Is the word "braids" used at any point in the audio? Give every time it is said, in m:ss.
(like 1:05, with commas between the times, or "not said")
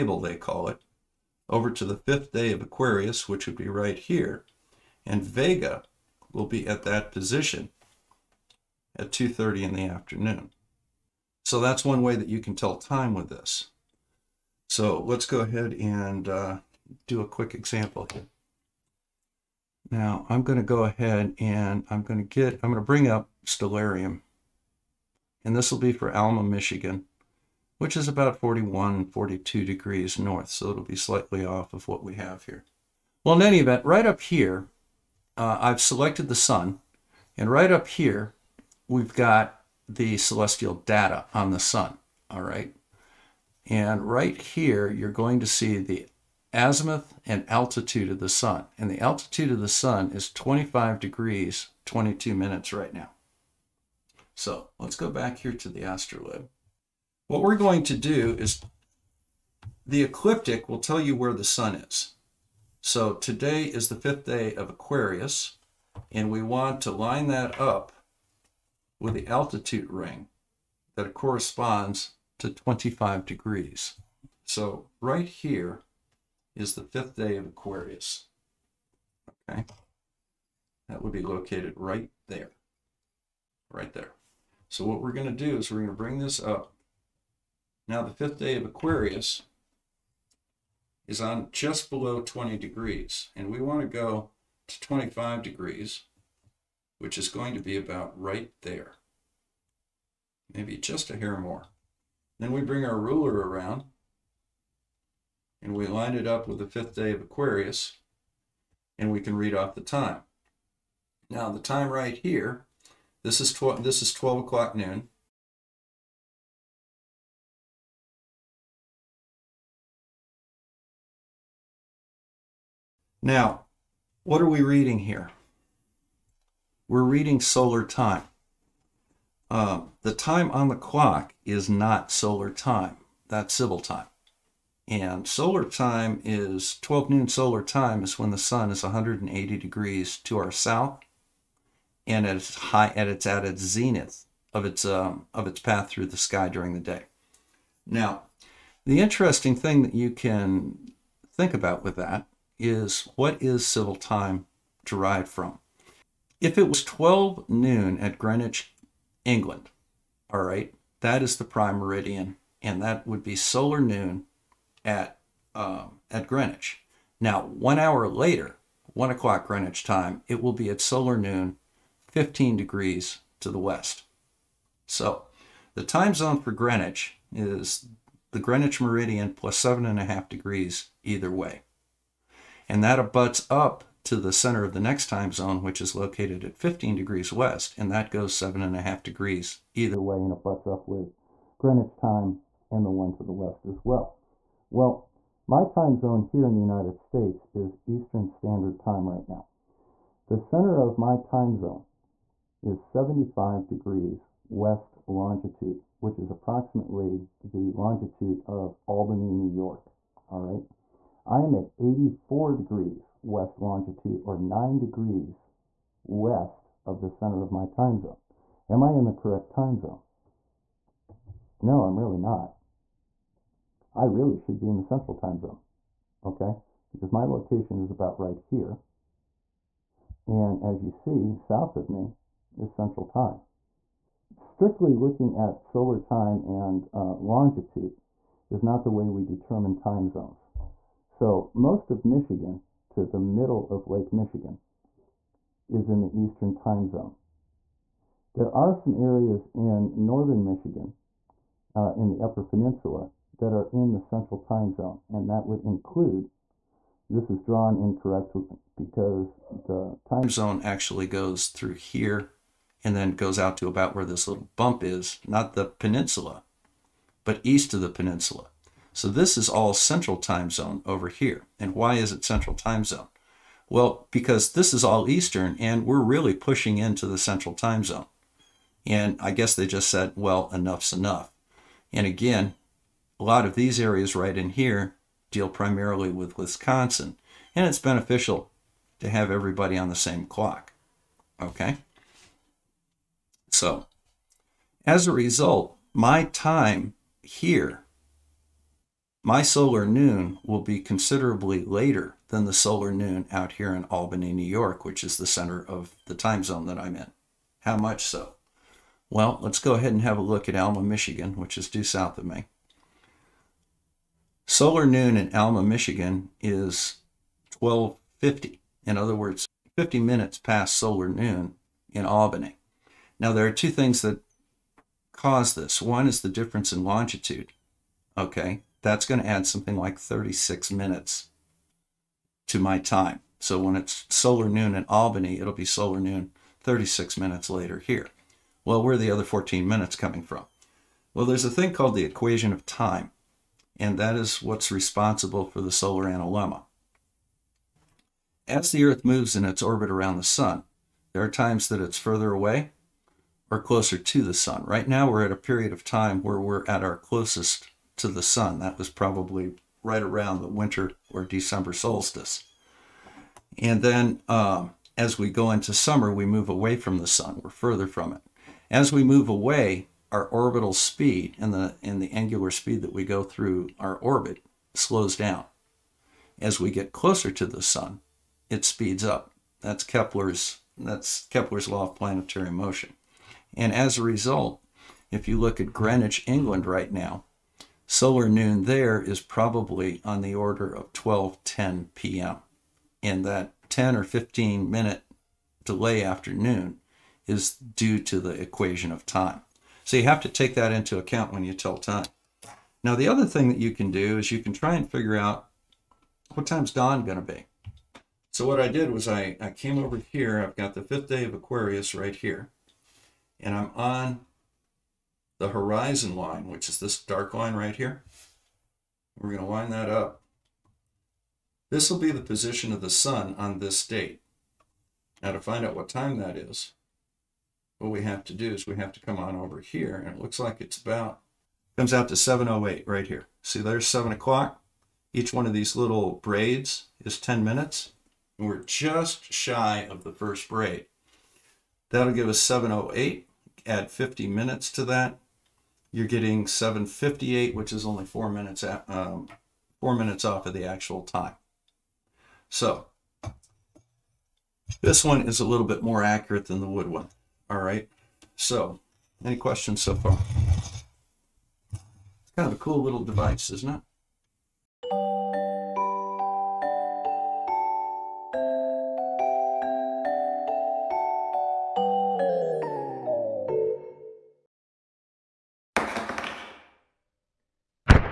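7:16, 7:20.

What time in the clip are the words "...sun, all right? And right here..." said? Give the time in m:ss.
0:41.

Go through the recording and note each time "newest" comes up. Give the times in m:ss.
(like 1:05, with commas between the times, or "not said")
not said.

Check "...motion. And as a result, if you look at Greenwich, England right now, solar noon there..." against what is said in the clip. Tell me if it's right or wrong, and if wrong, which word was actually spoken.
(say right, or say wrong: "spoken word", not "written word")
right.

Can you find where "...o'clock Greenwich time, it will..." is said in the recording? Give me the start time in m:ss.
2:49.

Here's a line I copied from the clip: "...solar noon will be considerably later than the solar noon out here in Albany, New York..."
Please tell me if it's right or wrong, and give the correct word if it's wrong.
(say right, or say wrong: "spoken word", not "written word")
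right.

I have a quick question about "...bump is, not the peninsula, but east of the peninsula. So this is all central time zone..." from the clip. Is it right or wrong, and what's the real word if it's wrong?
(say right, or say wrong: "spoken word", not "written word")
right.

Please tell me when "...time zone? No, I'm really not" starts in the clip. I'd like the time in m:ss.
3:39.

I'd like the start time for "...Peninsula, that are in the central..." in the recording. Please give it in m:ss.
4:12.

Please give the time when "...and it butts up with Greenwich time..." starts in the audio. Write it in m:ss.
3:10.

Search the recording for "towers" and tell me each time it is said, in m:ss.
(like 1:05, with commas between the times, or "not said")
not said.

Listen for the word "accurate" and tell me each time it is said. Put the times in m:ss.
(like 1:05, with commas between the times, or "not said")
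7:36.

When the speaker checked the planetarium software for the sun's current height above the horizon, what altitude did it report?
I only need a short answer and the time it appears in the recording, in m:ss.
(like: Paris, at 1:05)
25 degrees, 22 minutes, at 0:50.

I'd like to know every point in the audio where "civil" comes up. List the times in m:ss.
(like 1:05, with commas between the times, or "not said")
2:13, 2:33.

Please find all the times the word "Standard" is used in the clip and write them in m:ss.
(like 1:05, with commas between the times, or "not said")
3:18.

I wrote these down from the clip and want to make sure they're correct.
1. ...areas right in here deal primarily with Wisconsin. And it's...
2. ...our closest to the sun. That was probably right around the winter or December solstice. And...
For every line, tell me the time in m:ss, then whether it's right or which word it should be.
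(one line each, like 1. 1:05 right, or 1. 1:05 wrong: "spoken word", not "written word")
1. 4:43 right
2. 5:56 right.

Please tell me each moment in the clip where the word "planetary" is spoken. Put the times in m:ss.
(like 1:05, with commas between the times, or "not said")
6:21.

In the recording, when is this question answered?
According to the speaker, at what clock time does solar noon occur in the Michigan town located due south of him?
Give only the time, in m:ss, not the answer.
5:17.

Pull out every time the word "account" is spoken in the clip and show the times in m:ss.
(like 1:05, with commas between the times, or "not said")
6:40.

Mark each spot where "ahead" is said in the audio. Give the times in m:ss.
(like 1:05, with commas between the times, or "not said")
0:15, 0:20, 5:09.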